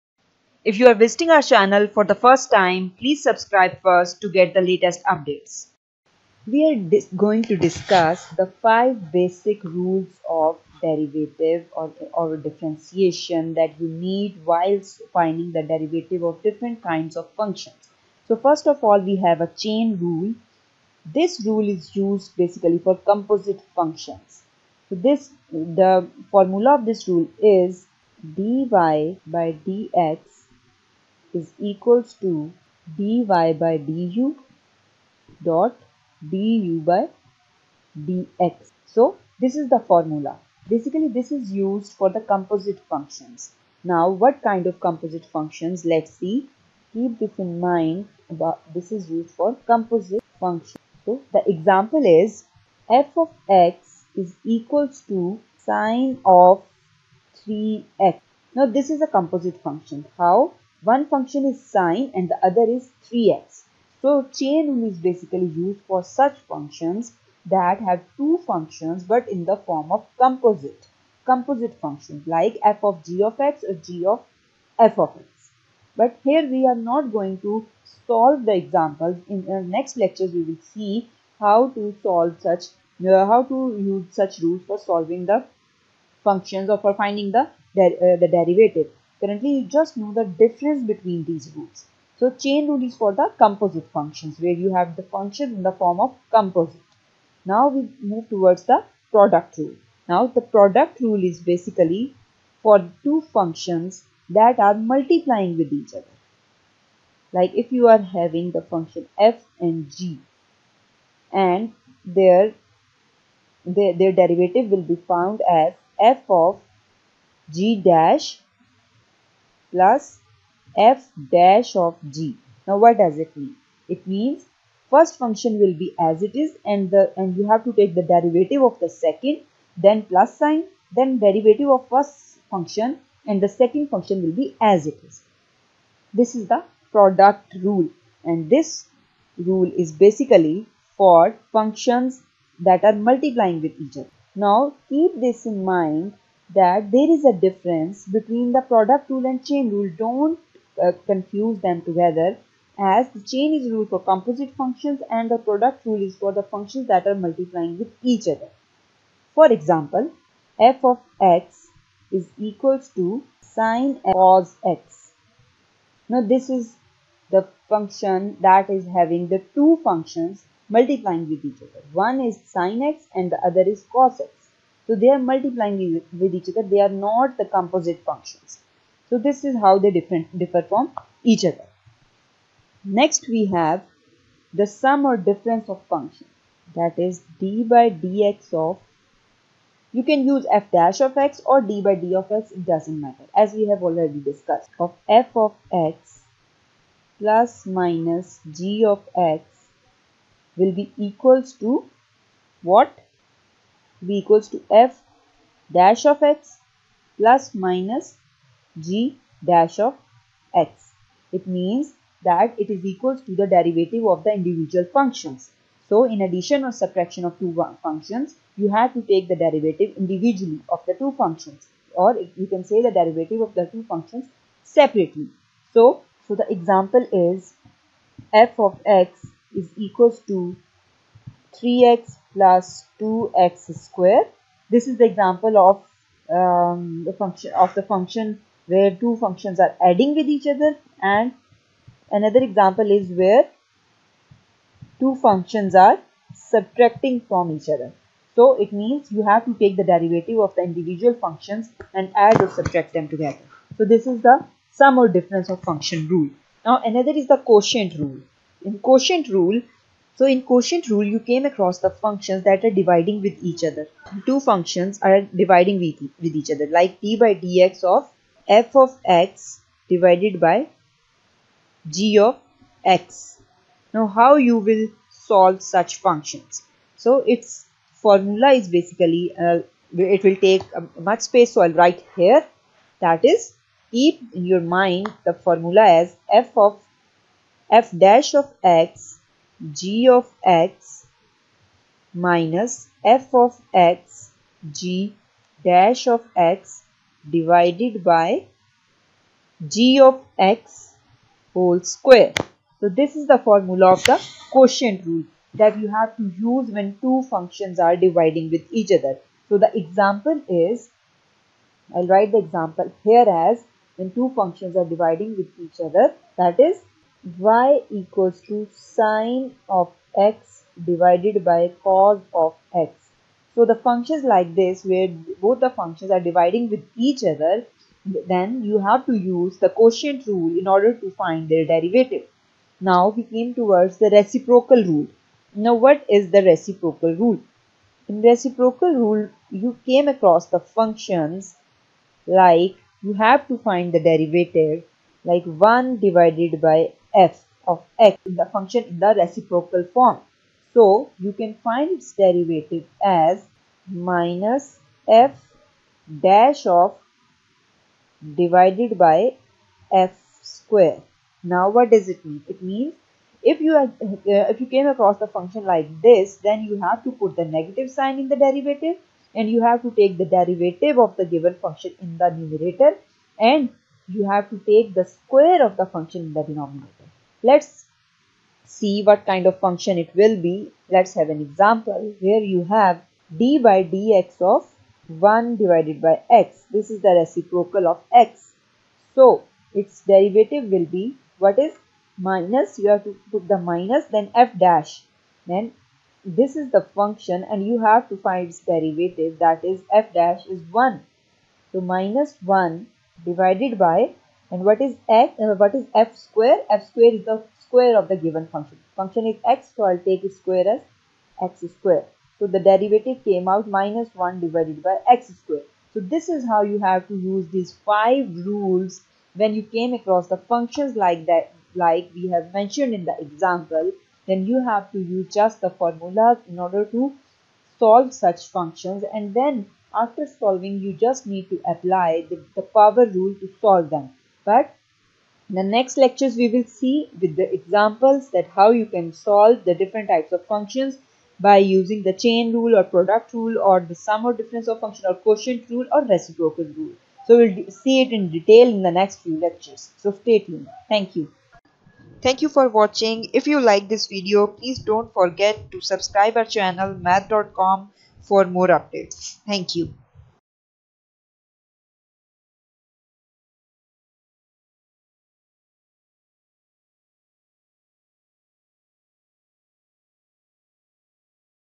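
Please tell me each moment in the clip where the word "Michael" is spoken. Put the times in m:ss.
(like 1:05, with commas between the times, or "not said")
not said.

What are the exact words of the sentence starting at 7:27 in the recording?
So we'll see it in detail in the next few lectures.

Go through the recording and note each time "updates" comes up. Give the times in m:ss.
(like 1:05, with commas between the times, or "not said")
0:05, 7:38.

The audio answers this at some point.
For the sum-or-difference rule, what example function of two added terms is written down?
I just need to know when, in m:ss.
3:51.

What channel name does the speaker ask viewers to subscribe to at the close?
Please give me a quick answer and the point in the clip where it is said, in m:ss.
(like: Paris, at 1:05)
math.com, at 7:36.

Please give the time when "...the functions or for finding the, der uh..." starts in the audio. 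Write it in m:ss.
1:25.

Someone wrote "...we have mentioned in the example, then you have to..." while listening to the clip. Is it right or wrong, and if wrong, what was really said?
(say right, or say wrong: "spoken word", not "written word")
right.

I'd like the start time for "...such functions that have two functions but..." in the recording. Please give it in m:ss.
1:06.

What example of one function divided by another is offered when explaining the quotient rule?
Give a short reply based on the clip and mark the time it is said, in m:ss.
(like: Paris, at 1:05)
sine of x divided by cos of x, at 5:18.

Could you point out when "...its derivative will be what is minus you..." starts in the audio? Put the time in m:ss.
6:29.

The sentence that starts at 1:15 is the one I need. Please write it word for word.
But here we are not going to solve the examples.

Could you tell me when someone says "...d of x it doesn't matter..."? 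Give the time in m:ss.
3:11.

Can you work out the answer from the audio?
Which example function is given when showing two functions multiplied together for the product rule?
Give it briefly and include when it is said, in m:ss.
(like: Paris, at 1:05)
sine cos x, at 2:43.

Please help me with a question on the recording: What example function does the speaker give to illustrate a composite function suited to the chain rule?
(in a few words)
sine of 3x.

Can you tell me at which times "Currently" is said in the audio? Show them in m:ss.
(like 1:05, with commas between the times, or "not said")
1:29.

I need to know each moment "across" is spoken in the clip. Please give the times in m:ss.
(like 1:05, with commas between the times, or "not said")
4:21, 5:40, 6:04, 6:59.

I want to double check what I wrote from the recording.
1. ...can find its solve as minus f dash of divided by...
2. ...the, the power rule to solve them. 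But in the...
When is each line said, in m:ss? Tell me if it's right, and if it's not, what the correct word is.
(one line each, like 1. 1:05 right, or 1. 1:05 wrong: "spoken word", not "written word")
1. 5:51 wrong: "derivative", not "solve"
2. 7:12 right.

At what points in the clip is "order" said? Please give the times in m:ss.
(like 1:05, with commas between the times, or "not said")
5:30, 7:06.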